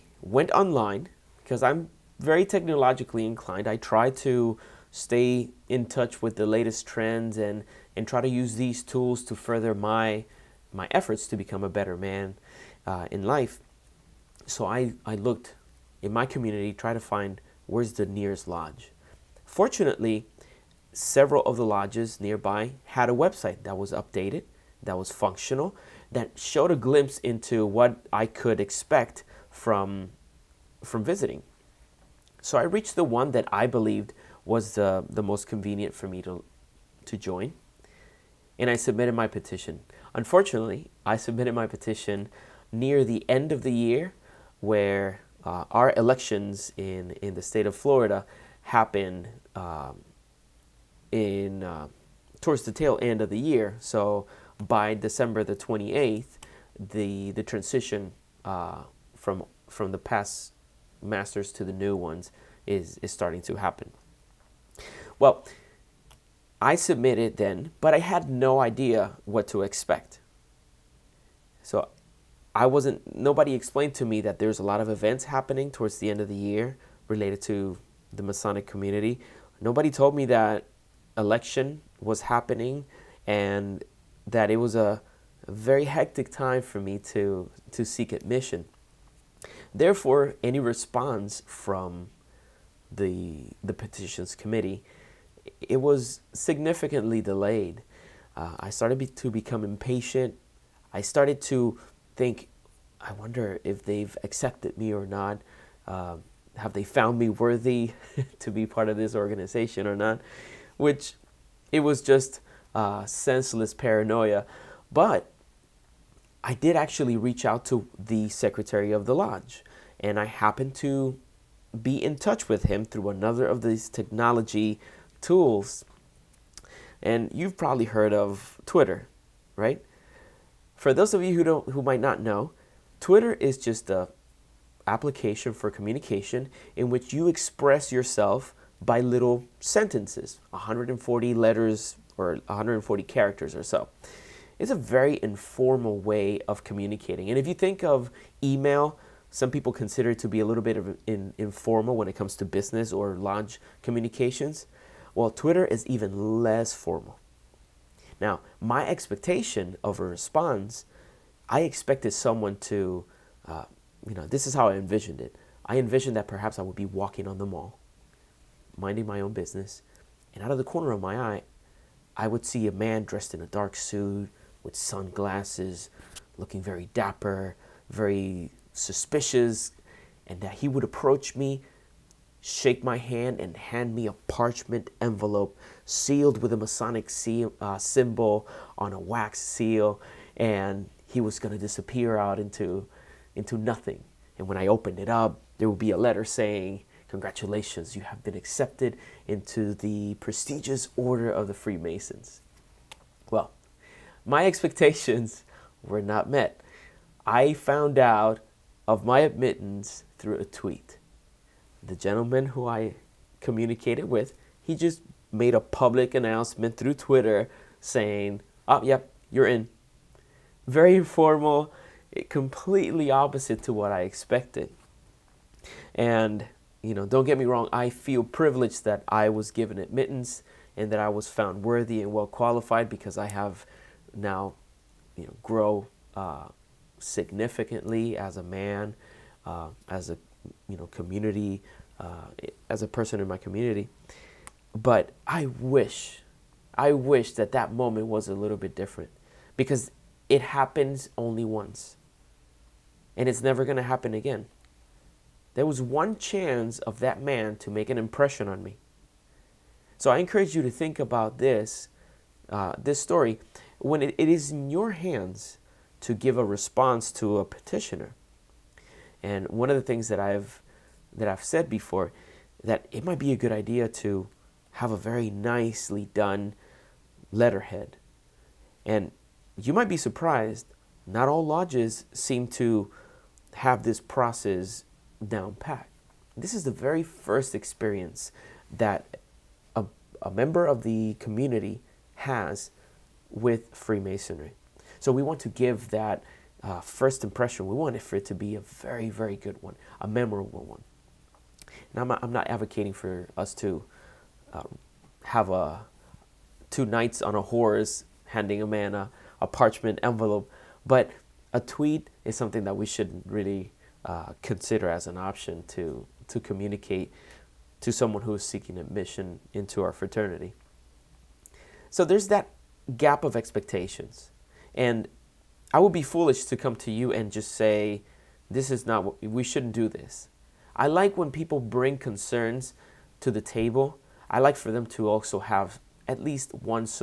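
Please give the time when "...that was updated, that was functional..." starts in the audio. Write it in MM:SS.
00:23.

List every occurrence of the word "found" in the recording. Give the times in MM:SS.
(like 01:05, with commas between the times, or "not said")
01:46, 03:27, 03:51.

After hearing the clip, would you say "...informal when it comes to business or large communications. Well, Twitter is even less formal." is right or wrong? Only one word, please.
right.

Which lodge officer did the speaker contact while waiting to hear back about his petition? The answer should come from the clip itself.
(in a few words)
the secretary.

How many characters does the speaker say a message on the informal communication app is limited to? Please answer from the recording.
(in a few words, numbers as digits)
140.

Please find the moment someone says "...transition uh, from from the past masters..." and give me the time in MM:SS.
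00:57.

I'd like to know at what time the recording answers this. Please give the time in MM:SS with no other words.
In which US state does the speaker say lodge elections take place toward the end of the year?
00:47.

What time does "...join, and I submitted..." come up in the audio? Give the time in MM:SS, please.
00:37.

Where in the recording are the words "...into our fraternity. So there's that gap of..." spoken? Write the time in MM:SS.
05:19.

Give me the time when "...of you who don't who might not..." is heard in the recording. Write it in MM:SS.
02:11.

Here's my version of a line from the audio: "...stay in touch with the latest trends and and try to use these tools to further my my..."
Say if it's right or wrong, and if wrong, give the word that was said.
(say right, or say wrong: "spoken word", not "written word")
right.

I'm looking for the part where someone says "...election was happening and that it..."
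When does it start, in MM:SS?
01:21.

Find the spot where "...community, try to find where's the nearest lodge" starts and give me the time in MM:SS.
00:16.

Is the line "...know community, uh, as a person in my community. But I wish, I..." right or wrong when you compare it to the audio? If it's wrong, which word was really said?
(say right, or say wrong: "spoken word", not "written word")
right.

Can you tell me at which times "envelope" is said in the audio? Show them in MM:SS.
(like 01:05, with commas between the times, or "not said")
03:04, 05:10.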